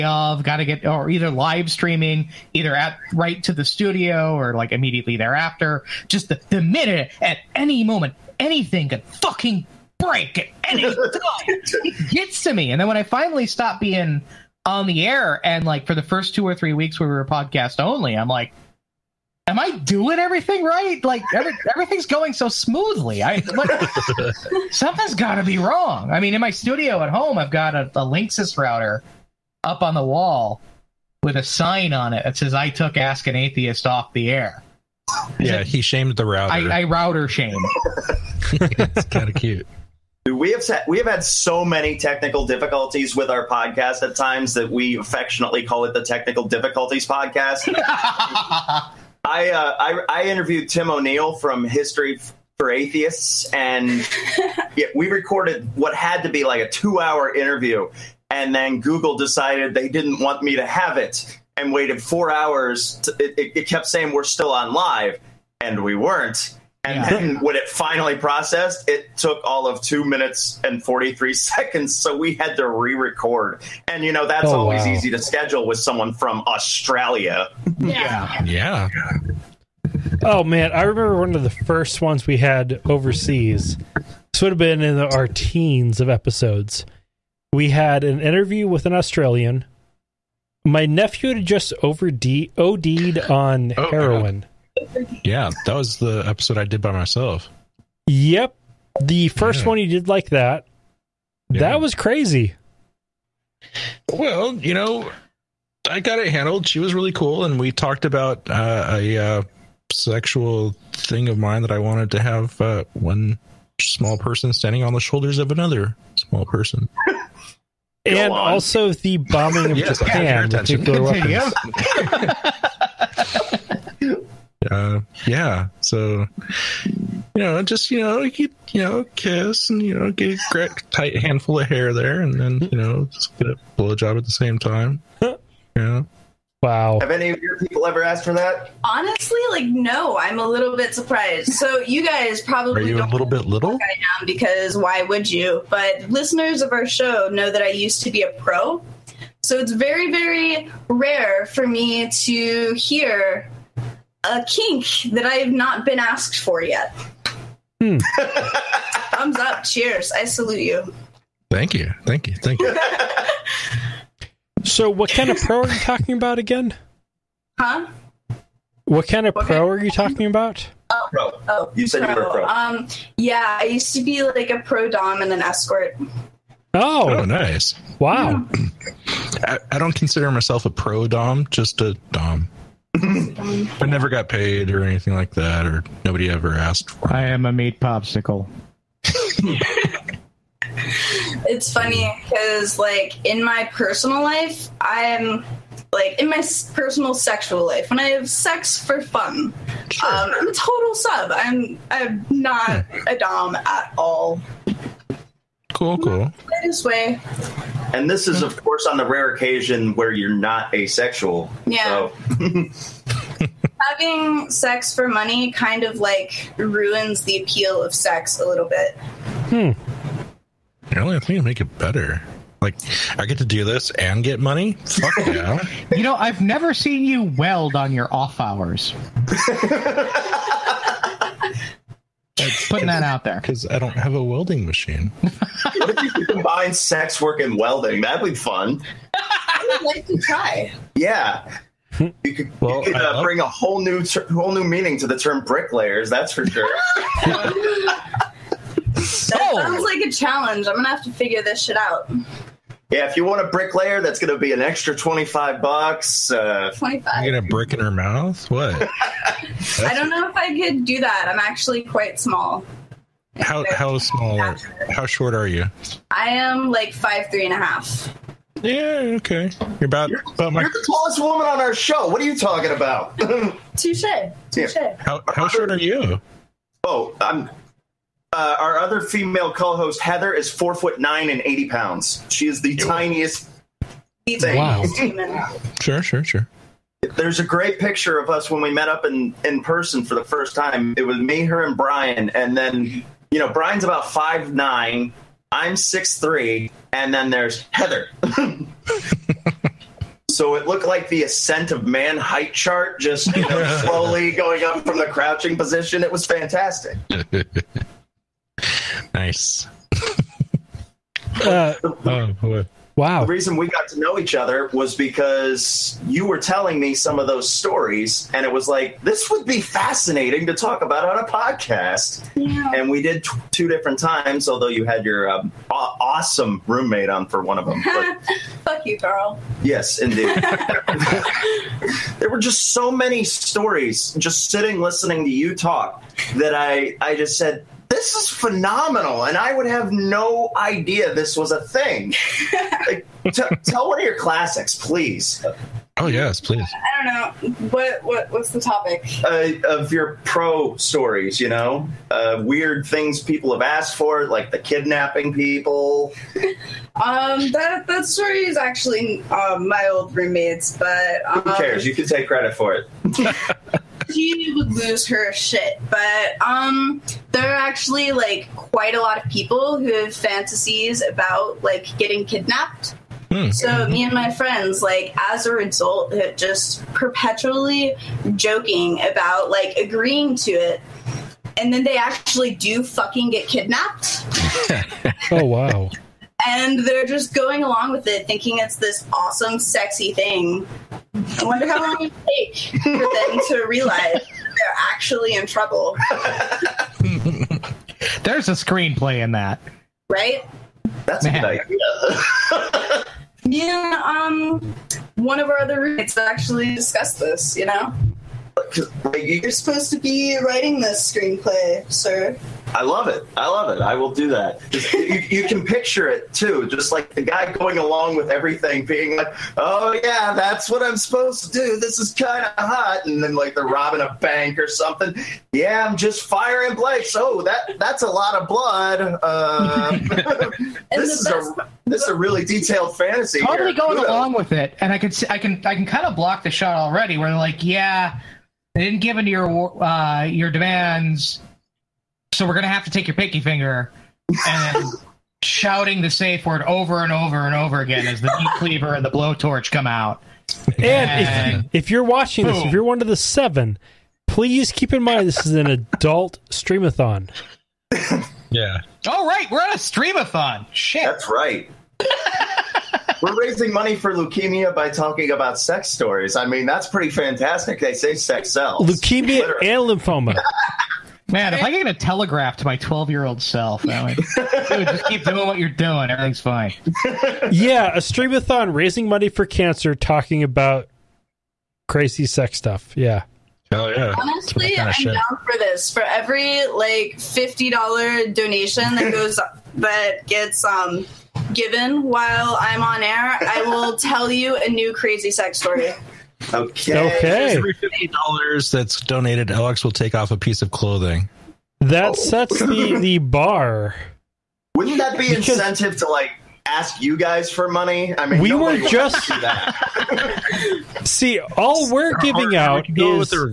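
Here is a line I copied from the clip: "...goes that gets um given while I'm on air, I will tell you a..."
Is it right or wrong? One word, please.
right.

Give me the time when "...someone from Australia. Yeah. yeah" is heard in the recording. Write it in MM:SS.
01:15.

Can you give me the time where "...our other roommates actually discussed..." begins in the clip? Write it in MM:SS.
06:45.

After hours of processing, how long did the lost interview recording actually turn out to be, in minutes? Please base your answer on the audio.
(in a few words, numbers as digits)
2 minutes and 43 seconds.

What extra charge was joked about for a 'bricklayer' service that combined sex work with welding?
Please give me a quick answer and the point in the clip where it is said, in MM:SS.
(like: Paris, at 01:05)
25 dollars, at 04:14.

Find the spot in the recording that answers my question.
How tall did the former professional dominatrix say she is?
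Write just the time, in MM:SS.
04:26.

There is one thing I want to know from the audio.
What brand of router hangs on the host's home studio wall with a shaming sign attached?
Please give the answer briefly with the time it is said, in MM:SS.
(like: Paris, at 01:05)
Linksys, at 00:28.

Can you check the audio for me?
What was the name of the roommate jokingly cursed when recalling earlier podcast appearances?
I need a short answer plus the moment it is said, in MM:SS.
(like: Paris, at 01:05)
Carl, at 05:28.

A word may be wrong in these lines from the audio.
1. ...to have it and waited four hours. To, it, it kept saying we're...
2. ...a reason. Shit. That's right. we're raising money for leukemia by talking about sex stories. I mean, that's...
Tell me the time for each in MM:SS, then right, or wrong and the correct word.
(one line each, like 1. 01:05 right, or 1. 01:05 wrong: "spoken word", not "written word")
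1. 01:00 right
2. 07:39 wrong: "streamathon", not "reason".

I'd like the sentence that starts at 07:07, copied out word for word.
Oh, that that's a lot of blood.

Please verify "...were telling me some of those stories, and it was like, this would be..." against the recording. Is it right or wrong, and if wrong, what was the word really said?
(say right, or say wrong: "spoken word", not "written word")
right.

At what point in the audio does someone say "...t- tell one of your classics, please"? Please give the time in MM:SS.
05:43.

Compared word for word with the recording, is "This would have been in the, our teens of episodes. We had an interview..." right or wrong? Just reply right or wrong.
right.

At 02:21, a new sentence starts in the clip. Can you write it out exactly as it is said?
So you guys probably are you a little bit little?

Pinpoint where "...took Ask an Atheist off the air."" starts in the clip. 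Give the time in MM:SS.
00:32.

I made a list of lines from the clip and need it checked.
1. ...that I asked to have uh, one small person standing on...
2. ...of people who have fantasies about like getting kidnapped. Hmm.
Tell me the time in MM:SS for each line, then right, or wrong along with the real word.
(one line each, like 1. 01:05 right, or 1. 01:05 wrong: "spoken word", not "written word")
1. 01:51 wrong: "wanted", not "asked"
2. 06:09 right.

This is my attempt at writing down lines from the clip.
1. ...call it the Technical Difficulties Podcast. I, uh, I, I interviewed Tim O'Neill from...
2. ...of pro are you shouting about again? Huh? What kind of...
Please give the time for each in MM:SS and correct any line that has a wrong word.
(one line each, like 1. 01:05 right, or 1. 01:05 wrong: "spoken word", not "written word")
1. 00:45 right
2. 02:45 wrong: "talking", not "shouting".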